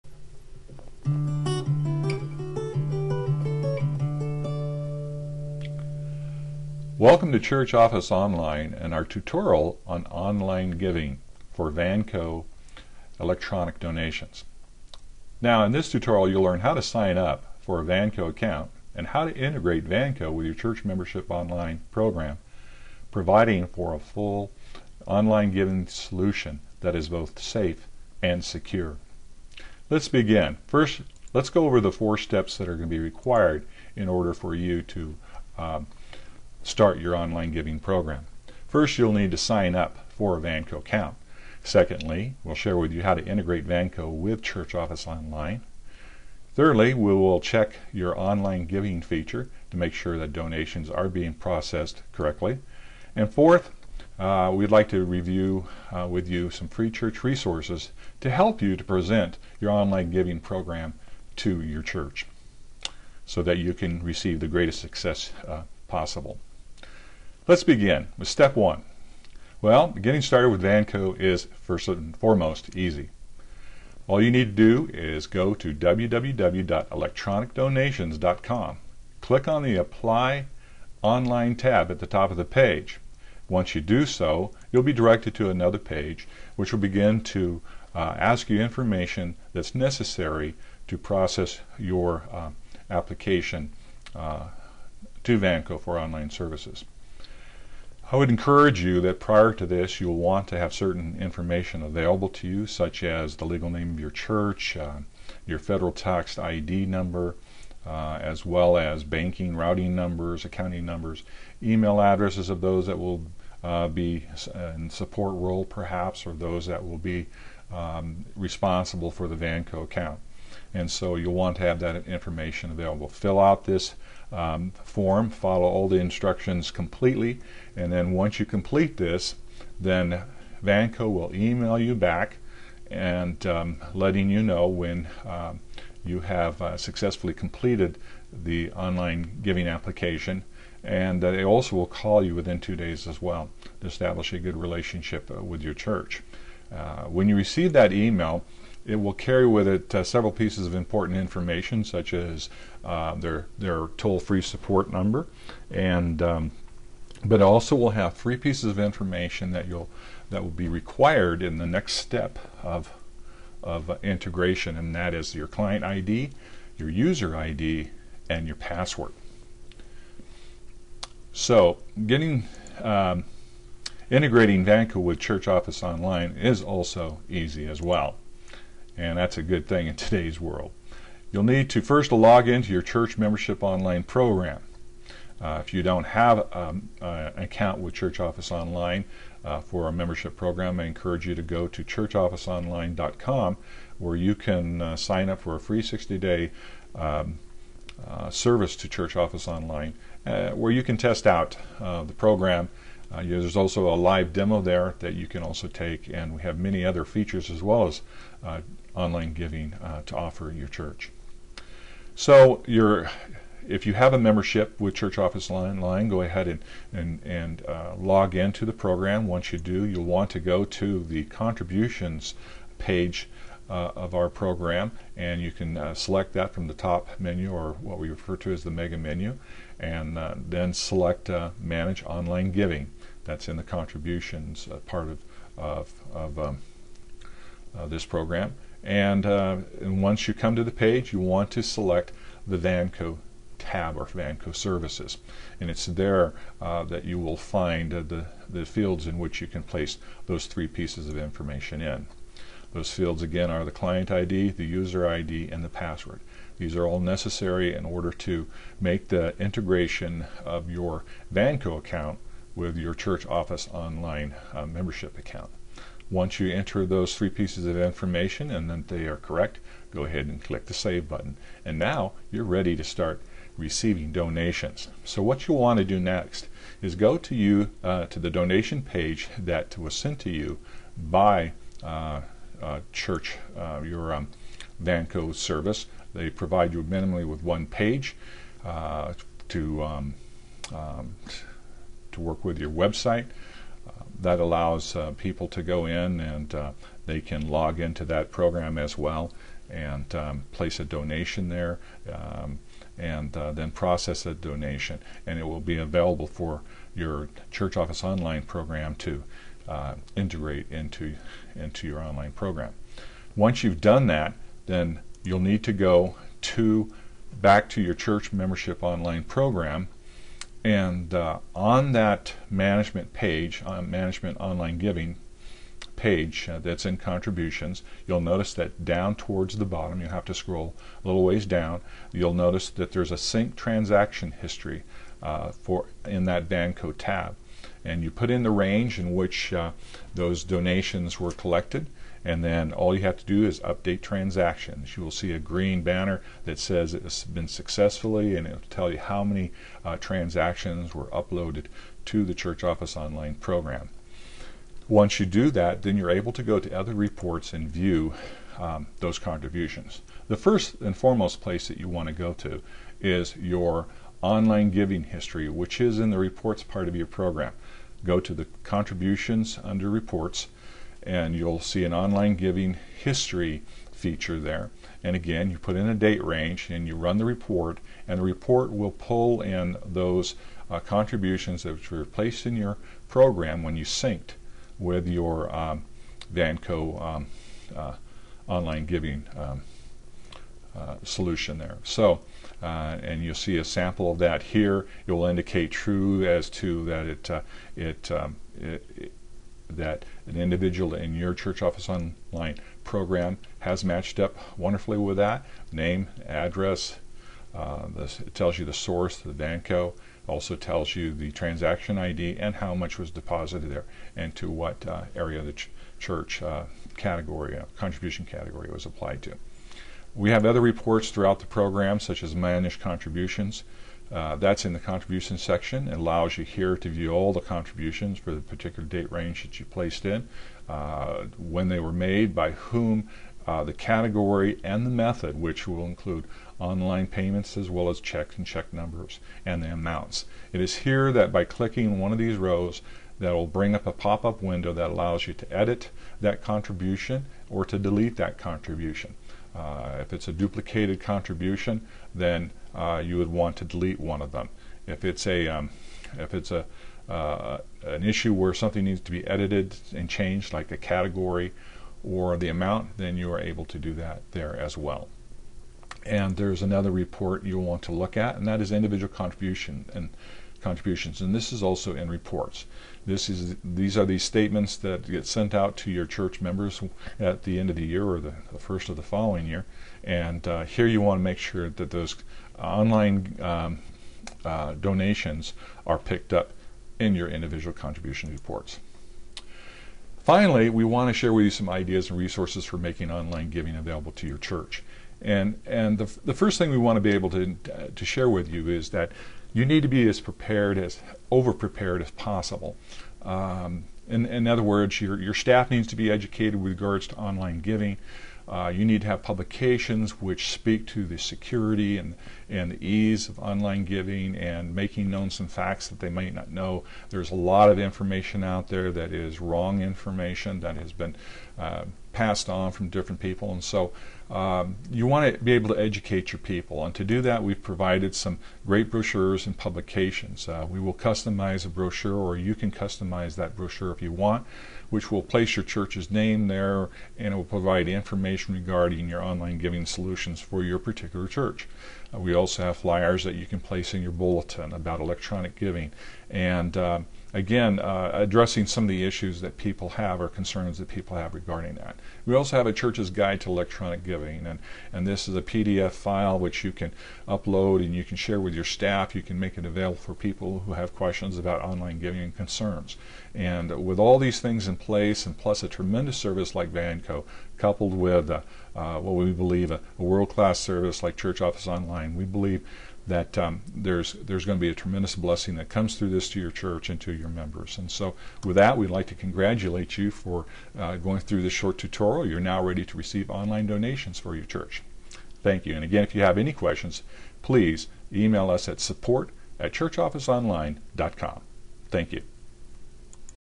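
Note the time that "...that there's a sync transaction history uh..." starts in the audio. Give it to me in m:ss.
5:32.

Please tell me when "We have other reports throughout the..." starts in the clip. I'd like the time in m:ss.
7:00.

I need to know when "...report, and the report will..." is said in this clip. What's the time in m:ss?
6:17.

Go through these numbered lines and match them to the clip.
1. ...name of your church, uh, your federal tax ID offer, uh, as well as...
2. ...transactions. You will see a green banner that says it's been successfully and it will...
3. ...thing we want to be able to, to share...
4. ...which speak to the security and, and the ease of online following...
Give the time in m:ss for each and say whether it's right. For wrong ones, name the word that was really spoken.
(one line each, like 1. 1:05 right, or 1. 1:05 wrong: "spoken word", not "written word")
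1. 1:43 wrong: "number", not "offer"
2. 5:44 right
3. 8:16 right
4. 8:30 wrong: "giving", not "following".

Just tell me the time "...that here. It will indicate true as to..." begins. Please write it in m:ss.
6:34.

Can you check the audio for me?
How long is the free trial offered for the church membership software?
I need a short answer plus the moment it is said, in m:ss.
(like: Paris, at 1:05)
60 days, at 3:15.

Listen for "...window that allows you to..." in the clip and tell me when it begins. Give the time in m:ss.
7:24.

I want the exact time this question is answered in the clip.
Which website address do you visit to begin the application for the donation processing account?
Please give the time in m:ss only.
1:15.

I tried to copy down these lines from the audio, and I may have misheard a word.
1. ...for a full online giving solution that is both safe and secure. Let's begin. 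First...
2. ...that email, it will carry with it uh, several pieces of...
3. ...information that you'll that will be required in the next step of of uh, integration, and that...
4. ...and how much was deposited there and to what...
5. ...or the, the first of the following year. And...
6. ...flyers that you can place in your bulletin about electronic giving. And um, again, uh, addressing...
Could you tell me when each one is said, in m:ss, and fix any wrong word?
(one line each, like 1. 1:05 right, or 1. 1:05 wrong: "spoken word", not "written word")
1. 0:23 right
2. 2:27 right
3. 2:38 right
4. 6:52 right
5. 7:58 right
6. 9:02 right.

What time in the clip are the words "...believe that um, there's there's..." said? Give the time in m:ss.
9:32.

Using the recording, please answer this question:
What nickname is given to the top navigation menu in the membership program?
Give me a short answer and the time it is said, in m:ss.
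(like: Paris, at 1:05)
mega menu, at 3:48.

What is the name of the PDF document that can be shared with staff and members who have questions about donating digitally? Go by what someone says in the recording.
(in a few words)
church's guide to electronic giving.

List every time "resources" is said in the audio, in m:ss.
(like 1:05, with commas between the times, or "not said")
0:57, 8:12.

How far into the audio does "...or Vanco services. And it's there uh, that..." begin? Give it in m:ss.
4:03.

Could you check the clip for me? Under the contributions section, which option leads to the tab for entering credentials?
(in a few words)
Manage Online Giving.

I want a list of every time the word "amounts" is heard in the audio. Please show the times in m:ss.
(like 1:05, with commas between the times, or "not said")
7:19, 7:42.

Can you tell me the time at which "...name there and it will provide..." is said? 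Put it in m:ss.
8:56.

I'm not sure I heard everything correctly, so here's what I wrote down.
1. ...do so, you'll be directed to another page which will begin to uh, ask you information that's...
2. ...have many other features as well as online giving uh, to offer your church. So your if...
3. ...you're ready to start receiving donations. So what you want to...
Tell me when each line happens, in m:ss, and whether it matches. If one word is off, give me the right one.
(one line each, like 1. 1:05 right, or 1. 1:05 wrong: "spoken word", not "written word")
1. 1:23 right
2. 3:26 right
3. 4:32 right.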